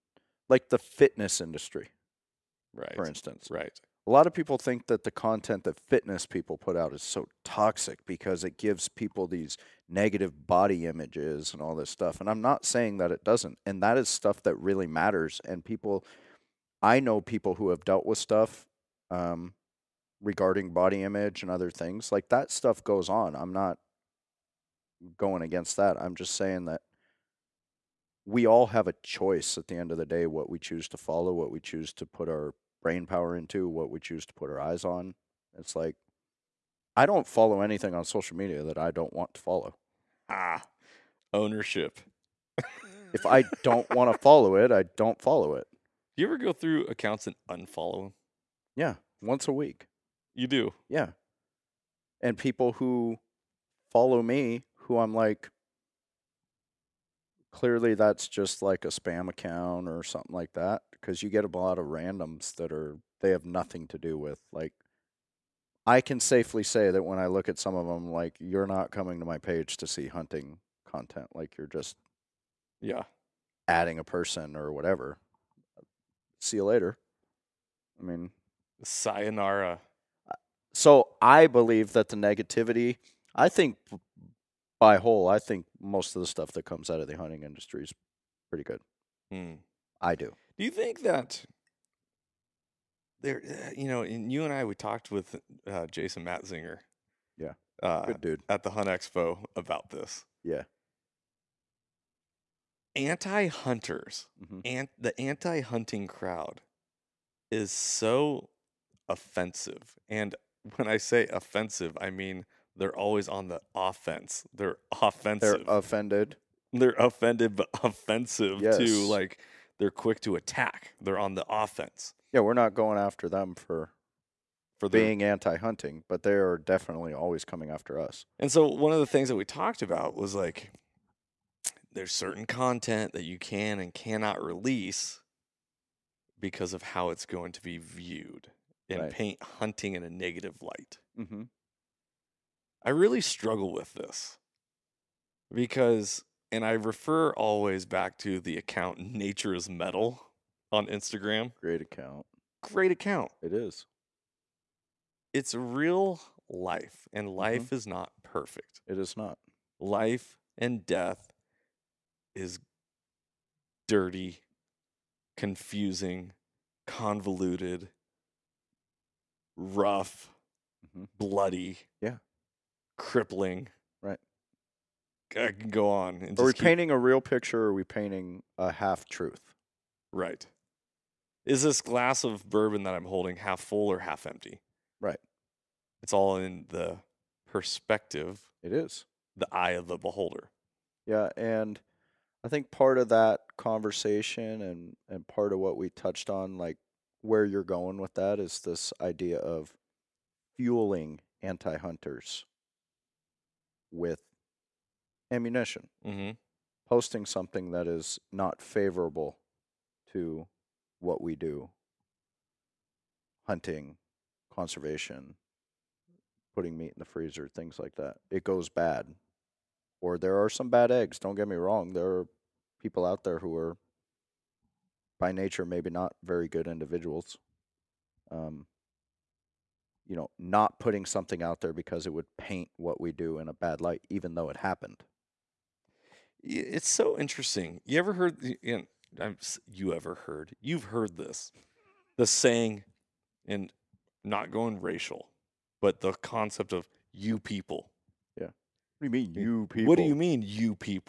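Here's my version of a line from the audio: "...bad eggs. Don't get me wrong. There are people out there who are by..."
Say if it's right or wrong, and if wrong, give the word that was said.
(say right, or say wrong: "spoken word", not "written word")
right.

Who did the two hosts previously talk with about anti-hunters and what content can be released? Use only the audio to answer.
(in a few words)
Jason Matzinger.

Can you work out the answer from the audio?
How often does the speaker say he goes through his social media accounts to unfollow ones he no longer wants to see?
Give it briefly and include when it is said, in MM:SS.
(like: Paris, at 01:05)
Once a week, at 00:49.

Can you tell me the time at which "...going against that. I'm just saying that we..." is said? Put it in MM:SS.
00:25.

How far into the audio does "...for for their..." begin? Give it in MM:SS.
02:03.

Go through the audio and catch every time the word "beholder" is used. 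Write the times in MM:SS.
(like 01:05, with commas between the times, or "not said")
03:09.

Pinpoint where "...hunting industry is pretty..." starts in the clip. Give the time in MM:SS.
01:27.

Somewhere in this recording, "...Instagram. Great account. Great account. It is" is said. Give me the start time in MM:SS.
02:30.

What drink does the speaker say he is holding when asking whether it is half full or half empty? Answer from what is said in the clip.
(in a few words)
Bourbon.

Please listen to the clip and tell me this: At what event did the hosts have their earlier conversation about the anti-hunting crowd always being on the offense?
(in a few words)
Hunt Expo.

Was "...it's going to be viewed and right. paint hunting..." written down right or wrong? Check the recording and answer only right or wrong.
right.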